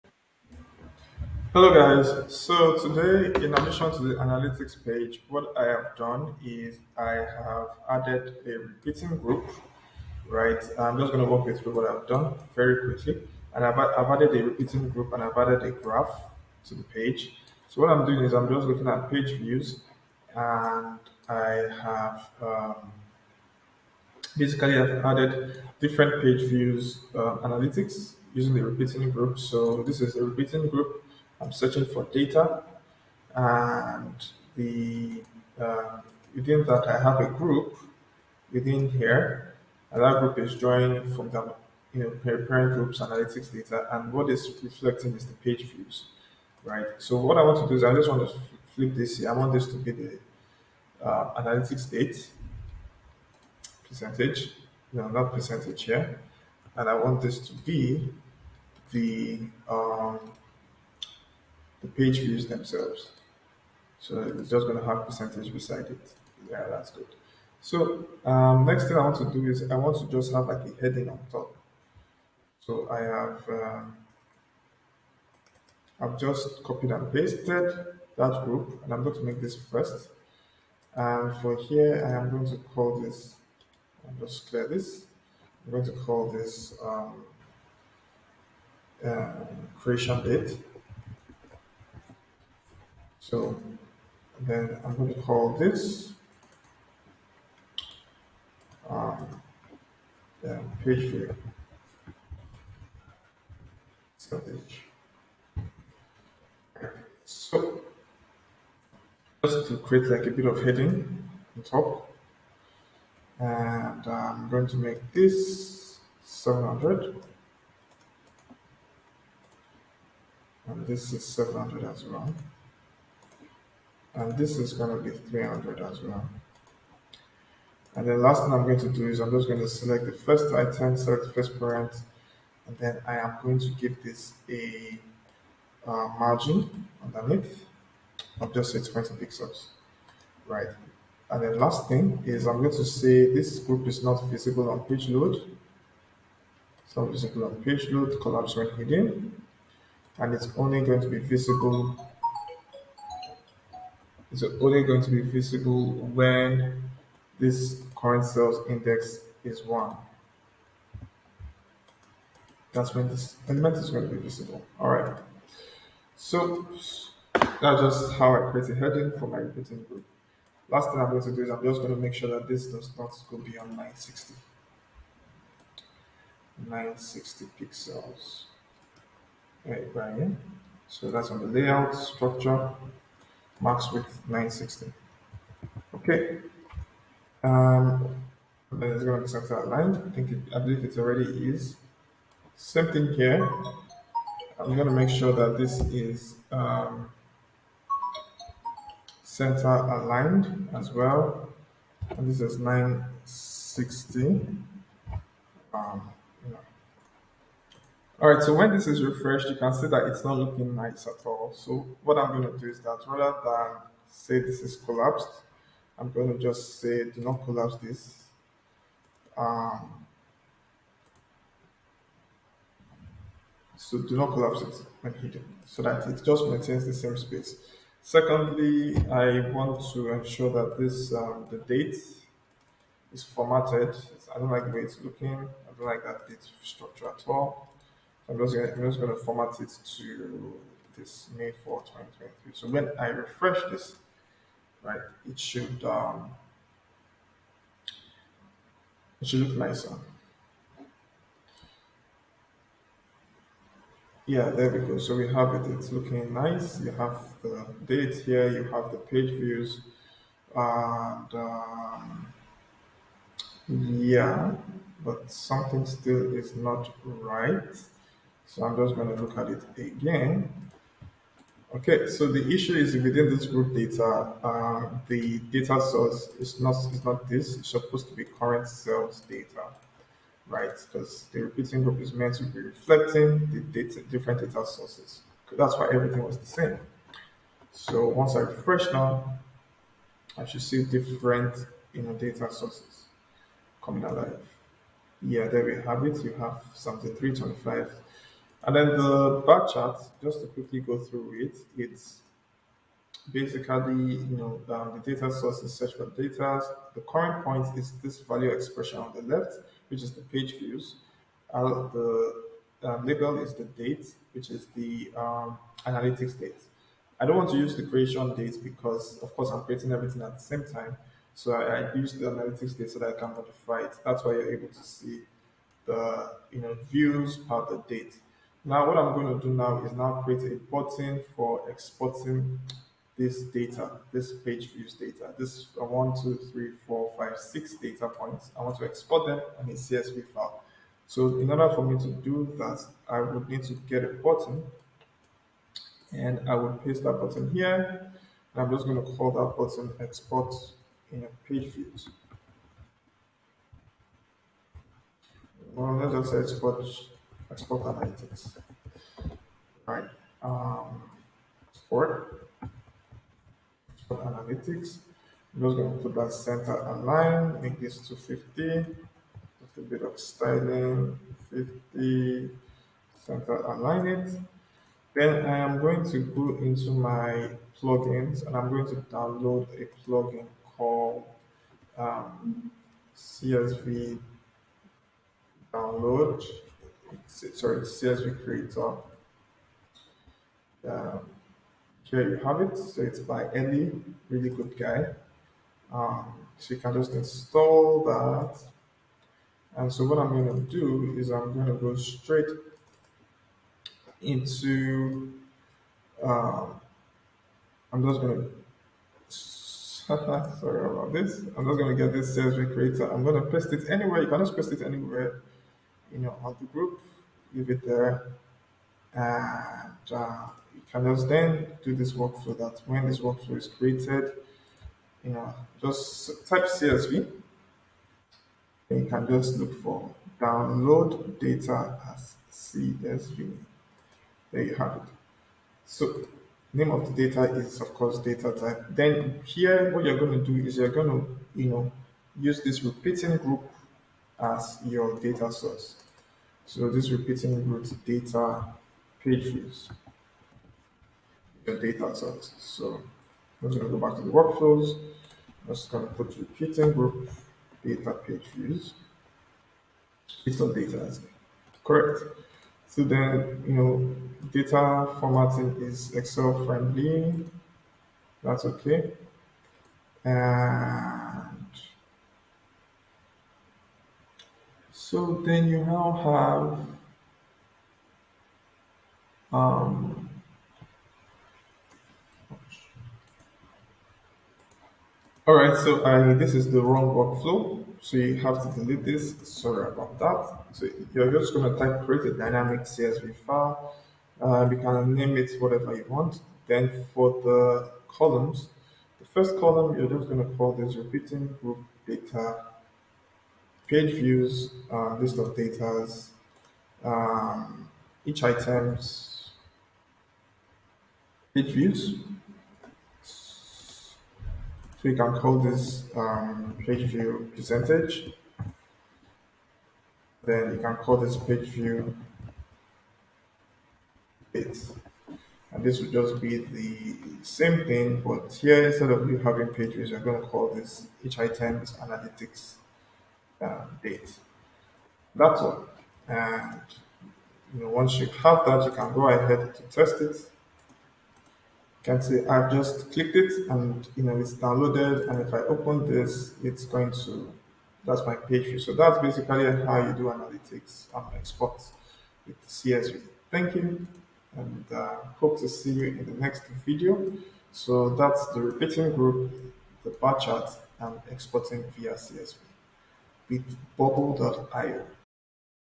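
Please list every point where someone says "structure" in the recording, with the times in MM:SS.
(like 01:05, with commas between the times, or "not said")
03:01, 03:56.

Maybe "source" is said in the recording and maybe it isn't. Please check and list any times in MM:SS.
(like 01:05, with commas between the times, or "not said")
04:35, 04:44, 04:52, 05:05, 07:25, 07:32.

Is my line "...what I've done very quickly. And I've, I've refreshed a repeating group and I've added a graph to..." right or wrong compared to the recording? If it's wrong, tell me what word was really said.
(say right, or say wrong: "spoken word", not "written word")
wrong: "added", not "refreshed".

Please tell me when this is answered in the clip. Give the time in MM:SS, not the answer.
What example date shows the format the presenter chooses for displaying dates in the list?
04:01.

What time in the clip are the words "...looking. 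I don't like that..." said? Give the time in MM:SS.
03:55.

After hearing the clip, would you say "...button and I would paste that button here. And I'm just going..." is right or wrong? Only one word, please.
right.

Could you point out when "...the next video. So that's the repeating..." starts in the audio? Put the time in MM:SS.
09:16.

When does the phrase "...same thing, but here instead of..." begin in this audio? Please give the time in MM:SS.
08:47.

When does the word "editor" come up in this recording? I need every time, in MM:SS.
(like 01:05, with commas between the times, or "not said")
not said.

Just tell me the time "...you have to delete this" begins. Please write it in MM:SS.
08:08.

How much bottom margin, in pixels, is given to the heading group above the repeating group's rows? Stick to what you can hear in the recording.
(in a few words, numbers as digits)
6.2 pixels.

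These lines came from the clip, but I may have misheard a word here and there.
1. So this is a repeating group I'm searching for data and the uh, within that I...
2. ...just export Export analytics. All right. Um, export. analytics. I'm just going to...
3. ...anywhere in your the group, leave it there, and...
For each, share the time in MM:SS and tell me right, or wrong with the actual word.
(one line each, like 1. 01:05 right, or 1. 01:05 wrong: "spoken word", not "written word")
1. 00:29 right
2. 05:56 right
3. 06:54 right.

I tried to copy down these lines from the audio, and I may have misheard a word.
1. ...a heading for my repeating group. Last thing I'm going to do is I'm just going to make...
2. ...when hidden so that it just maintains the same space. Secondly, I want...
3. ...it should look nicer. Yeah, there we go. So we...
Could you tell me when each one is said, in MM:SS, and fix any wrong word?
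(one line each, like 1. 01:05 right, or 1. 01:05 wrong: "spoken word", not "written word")
1. 02:48 right
2. 03:45 right
3. 04:09 right.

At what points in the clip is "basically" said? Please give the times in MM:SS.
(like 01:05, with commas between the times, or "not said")
00:24, 05:03, 09:09.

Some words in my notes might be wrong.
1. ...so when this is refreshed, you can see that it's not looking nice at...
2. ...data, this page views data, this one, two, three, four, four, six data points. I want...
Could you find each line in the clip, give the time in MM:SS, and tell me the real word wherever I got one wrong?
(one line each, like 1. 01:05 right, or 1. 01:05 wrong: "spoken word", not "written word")
1. 03:28 right
2. 05:33 wrong: "five", not "four".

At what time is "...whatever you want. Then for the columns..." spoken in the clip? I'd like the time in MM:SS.
08:15.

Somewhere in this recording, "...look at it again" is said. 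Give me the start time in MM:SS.
04:29.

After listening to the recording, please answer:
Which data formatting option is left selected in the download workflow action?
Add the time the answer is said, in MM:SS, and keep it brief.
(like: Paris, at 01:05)
Excel friendly, at 07:46.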